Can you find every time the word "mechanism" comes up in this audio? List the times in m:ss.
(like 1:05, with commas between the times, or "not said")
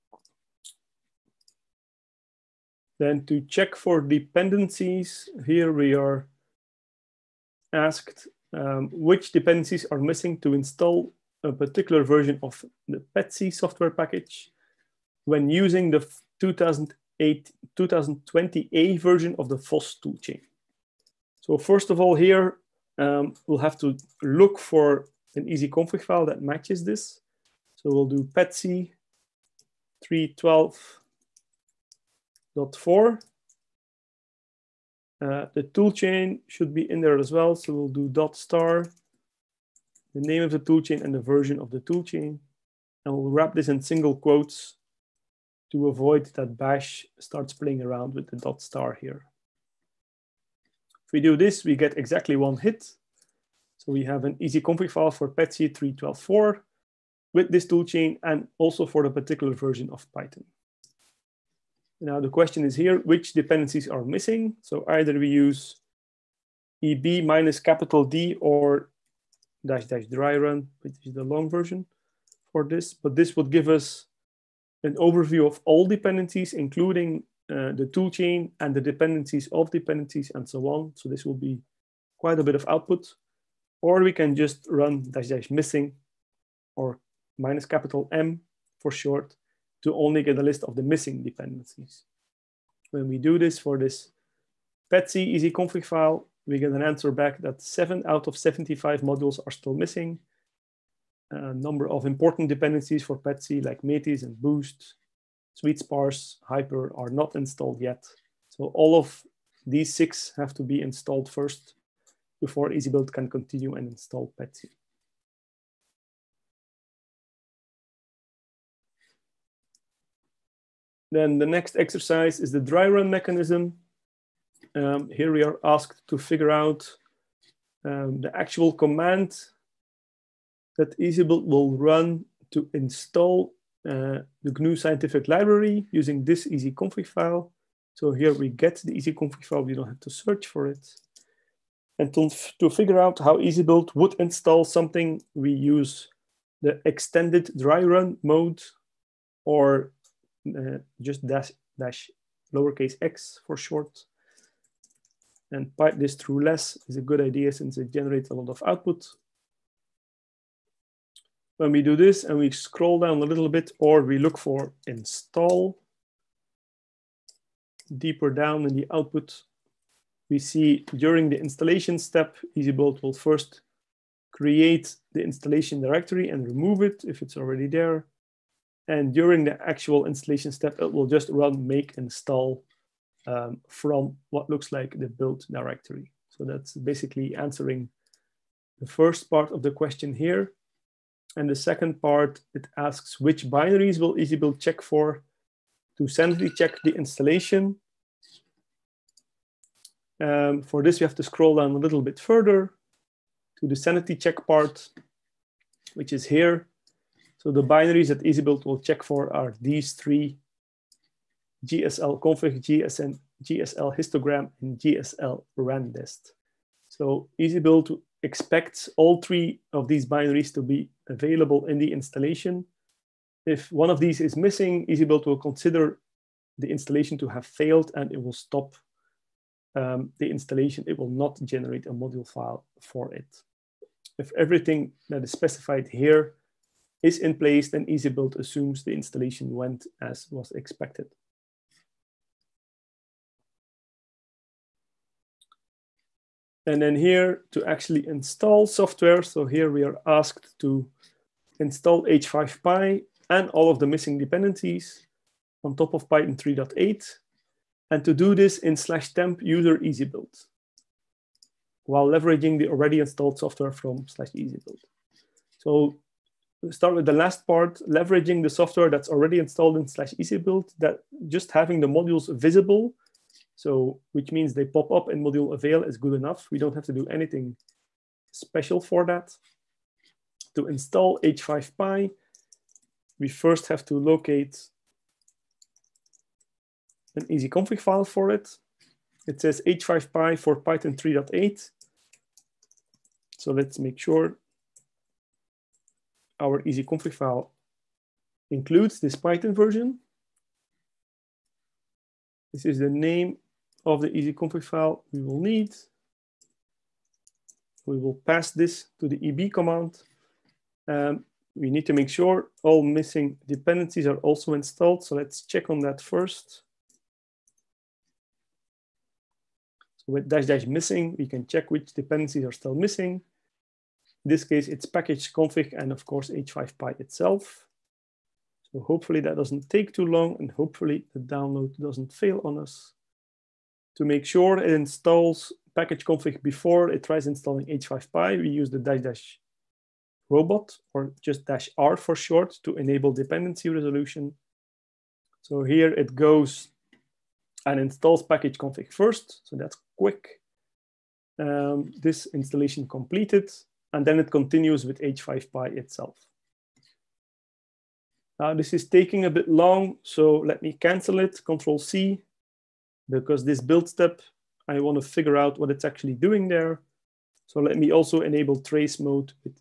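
2:03.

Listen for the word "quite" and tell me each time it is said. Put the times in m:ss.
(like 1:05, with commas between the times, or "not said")
1:22.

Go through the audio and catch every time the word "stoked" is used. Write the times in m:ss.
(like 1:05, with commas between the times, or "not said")
not said.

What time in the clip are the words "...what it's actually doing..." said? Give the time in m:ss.
6:05.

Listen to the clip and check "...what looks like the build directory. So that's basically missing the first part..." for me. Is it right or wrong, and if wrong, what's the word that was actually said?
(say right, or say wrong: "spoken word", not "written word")
wrong: "answering", not "missing".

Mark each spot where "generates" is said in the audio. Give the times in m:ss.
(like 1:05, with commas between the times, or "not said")
2:37, 3:51.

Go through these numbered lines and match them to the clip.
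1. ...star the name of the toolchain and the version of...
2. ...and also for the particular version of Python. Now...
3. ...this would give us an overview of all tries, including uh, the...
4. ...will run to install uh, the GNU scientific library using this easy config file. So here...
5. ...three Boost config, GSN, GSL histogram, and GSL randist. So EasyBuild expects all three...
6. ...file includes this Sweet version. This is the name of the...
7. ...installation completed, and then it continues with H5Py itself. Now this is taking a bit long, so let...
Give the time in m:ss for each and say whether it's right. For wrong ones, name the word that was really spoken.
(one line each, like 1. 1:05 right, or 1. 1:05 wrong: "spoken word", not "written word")
1. 0:38 right
2. 0:58 right
3. 1:13 wrong: "dependencies", not "tries"
4. 2:11 right
5. 3:29 wrong: "GSL", not "Boost"
6. 4:57 wrong: "Python", not "Sweet"
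7. 5:52 right.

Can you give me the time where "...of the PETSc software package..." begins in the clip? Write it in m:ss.
0:12.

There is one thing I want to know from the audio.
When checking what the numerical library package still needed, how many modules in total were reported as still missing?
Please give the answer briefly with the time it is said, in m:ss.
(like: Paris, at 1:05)
7, at 1:37.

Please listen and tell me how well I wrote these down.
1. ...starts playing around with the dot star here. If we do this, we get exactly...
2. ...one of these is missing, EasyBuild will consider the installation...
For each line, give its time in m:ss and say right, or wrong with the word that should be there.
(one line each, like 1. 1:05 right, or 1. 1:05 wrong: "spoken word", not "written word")
1. 0:47 right
2. 3:43 right.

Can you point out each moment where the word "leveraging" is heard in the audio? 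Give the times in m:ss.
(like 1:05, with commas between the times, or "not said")
4:22, 4:27.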